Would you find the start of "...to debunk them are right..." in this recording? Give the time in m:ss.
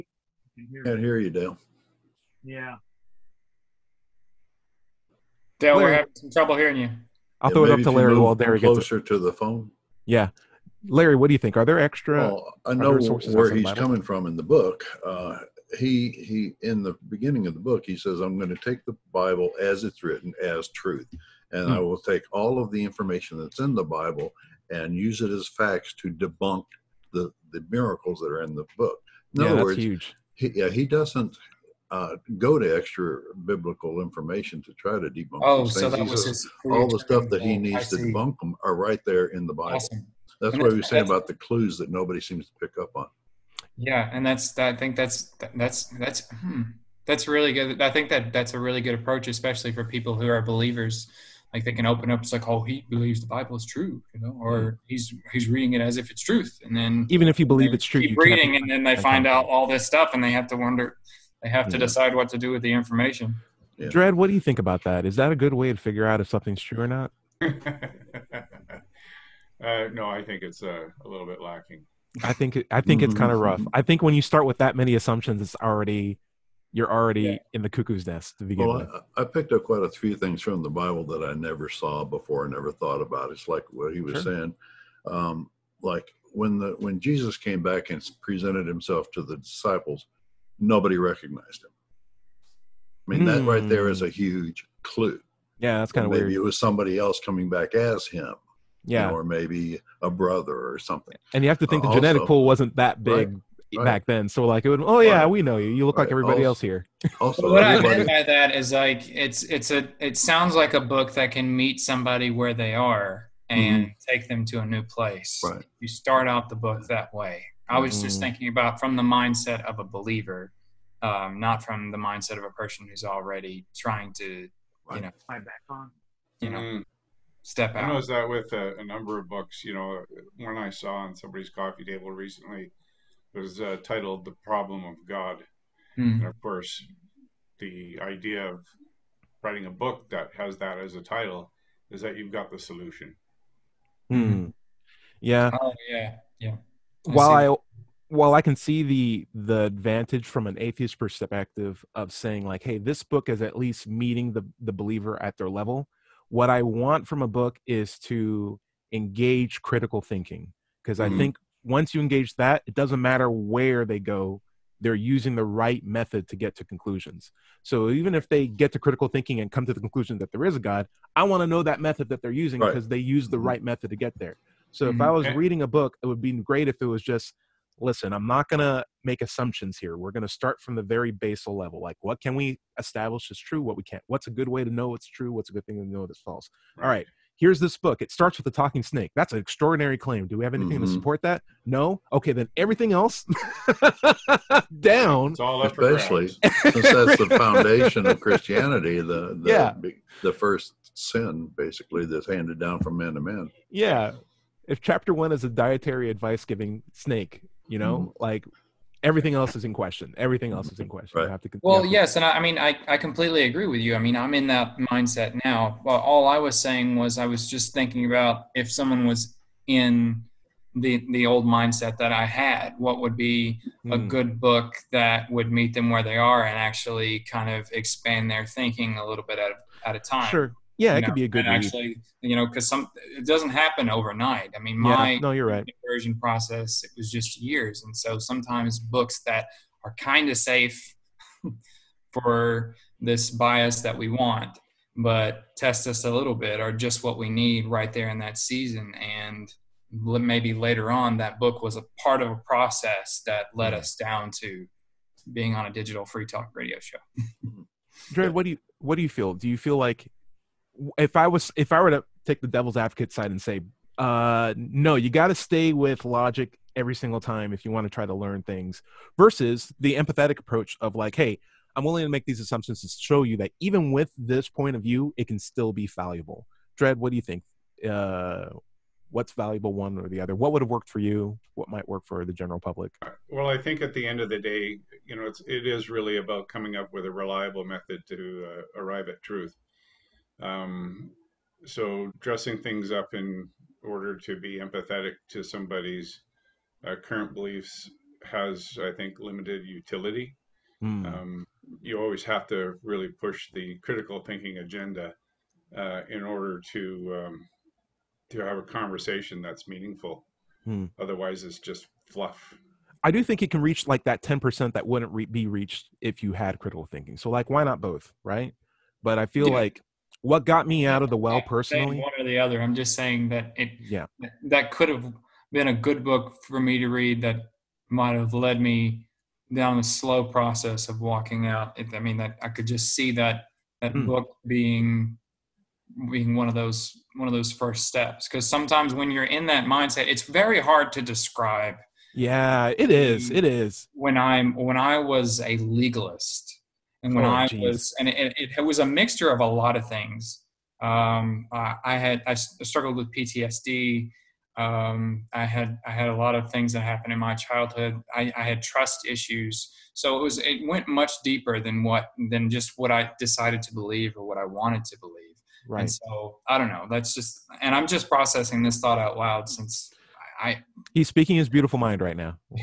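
0:37.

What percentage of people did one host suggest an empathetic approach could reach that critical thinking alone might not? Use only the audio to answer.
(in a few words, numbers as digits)
10%.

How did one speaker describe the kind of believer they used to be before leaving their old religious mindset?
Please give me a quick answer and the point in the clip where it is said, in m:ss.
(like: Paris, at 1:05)
A legalist, at 5:45.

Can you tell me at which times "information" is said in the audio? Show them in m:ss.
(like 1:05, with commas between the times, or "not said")
0:22, 0:33, 1:02.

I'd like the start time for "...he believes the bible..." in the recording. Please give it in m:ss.
0:52.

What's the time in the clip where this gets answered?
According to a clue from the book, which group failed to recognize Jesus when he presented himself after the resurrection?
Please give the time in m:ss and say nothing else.
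1:29.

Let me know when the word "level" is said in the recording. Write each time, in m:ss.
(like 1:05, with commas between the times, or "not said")
2:35, 3:01.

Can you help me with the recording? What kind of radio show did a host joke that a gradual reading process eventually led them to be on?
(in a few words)
Digital free talk radio.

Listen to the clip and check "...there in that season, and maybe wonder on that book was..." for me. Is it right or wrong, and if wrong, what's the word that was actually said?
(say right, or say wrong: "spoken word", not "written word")
wrong: "later", not "wonder".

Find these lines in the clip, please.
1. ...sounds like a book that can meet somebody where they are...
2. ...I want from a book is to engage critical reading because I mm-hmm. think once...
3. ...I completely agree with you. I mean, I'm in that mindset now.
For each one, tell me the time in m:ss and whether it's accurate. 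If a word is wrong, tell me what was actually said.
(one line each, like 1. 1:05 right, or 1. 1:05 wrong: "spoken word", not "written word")
1. 1:50 right
2. 2:36 wrong: "thinking", not "reading"
3. 3:32 right.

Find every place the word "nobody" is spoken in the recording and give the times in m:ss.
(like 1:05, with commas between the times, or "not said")
0:41, 1:30.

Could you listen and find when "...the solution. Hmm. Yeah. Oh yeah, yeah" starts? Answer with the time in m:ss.
2:22.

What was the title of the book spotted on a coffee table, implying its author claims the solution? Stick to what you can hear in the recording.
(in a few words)
The Problem of God.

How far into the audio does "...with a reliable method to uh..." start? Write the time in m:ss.
4:46.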